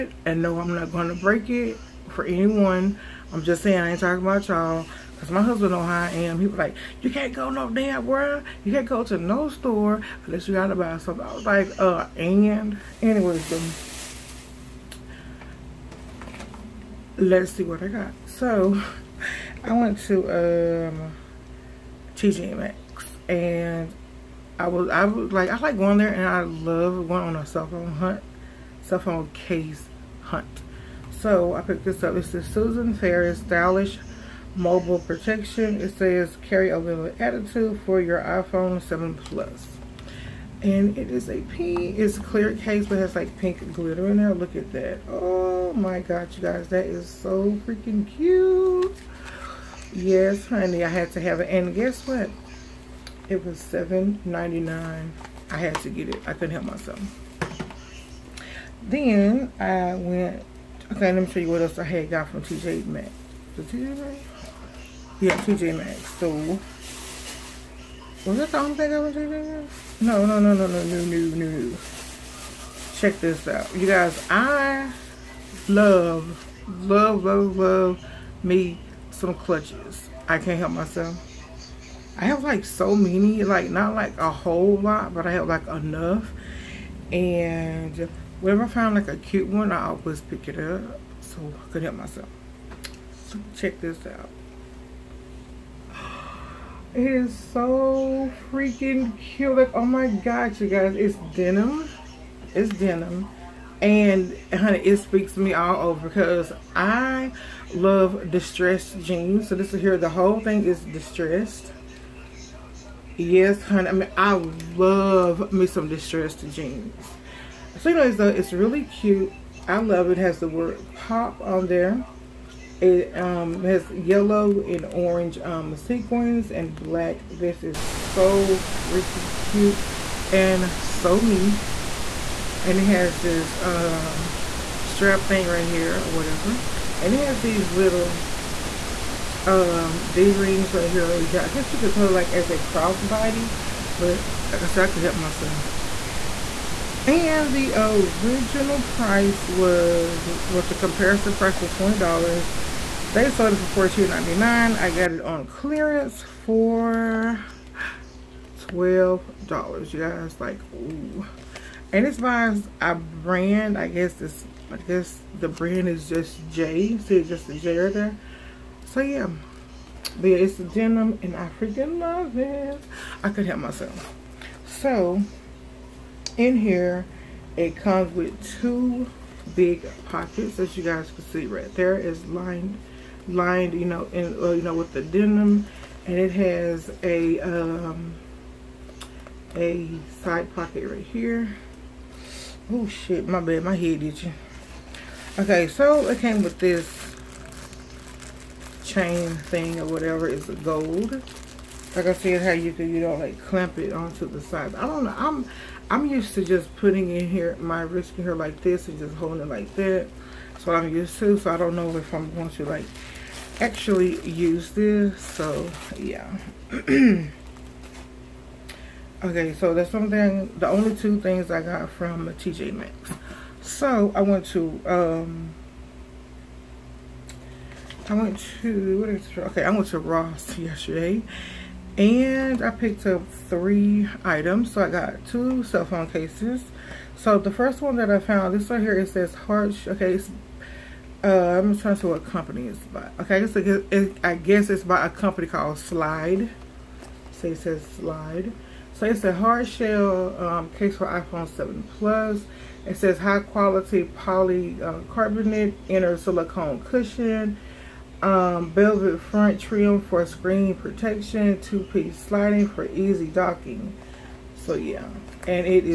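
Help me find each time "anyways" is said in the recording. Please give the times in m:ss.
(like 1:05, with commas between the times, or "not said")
0:13, 1:57.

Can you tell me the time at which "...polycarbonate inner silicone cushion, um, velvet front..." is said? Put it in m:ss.
4:14.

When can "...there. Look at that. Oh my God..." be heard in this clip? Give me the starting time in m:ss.
0:44.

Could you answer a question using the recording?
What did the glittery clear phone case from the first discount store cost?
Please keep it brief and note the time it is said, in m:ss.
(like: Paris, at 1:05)
$7.99, at 0:53.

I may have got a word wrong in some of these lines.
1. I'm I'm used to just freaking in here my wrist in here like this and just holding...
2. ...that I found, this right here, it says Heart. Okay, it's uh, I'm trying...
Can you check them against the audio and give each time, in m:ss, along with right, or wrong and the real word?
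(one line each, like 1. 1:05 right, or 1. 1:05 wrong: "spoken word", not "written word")
1. 3:25 wrong: "putting", not "freaking"
2. 3:57 right.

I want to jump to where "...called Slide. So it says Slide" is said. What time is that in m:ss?
4:05.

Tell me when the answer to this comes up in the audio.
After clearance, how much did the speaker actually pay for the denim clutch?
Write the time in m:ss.
2:38.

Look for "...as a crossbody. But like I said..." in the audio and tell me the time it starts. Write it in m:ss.
2:22.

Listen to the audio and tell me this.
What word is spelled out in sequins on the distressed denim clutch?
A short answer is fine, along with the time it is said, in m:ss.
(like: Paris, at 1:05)
pop, at 2:00.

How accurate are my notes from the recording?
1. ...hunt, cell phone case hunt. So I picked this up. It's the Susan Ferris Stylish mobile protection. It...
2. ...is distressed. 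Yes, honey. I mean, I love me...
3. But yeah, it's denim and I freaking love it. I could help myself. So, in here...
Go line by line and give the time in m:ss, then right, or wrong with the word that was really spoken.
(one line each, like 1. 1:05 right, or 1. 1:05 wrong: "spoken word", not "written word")
1. 0:27 right
2. 1:50 right
3. 2:50 right.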